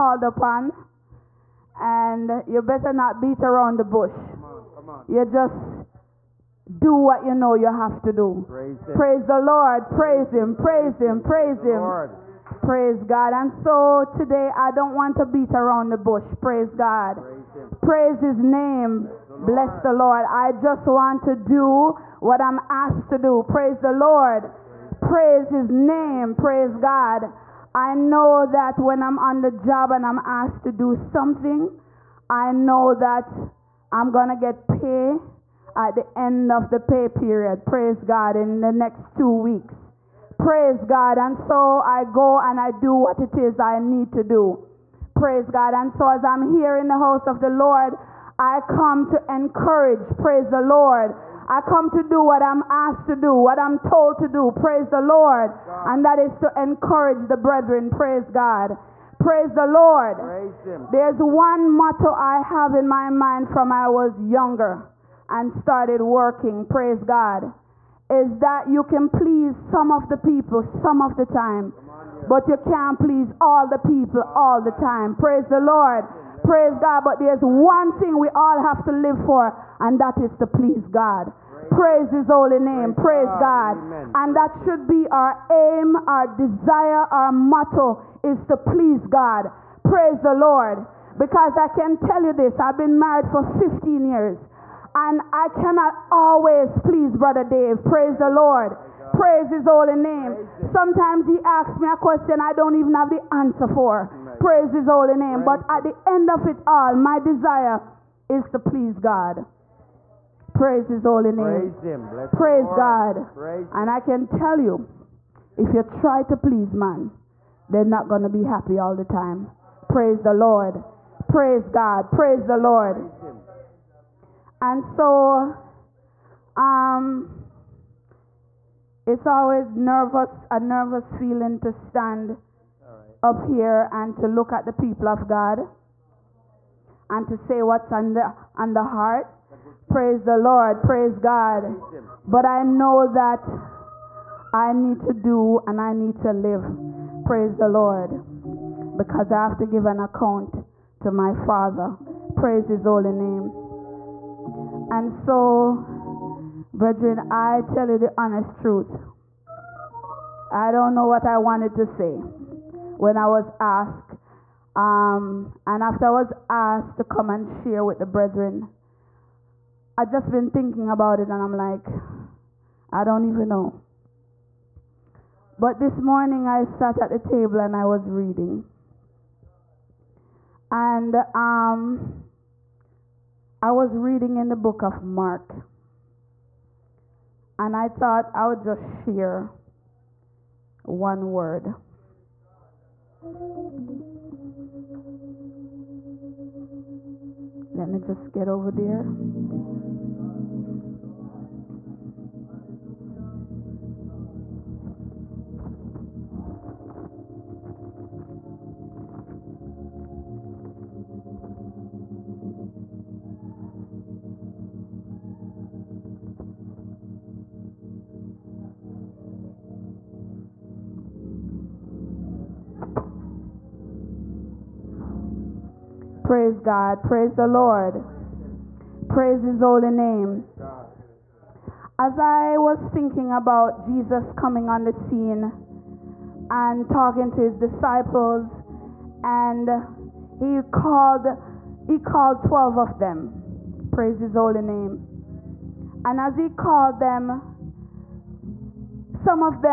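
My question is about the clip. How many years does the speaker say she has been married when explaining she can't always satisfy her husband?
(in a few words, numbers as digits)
15.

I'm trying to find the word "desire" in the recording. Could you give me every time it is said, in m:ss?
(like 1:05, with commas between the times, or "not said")
1:26, 1:47.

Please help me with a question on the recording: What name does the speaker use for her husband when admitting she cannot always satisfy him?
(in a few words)
Brother Dave.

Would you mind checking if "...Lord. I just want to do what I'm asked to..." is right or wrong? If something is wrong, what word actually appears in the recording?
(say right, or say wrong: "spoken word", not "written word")
right.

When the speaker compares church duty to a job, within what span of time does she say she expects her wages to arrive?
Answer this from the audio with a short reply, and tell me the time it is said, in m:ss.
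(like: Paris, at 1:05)
2 weeks, at 0:39.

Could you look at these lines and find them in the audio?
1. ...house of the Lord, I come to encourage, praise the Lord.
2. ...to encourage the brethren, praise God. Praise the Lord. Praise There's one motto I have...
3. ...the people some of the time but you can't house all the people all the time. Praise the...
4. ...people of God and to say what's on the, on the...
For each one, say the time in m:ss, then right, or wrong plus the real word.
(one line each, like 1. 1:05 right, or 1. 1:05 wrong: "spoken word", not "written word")
1. 0:46 right
2. 0:56 right
3. 1:10 wrong: "please", not "house"
4. 2:14 right.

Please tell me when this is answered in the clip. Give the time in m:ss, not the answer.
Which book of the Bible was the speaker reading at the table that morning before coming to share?
3:04.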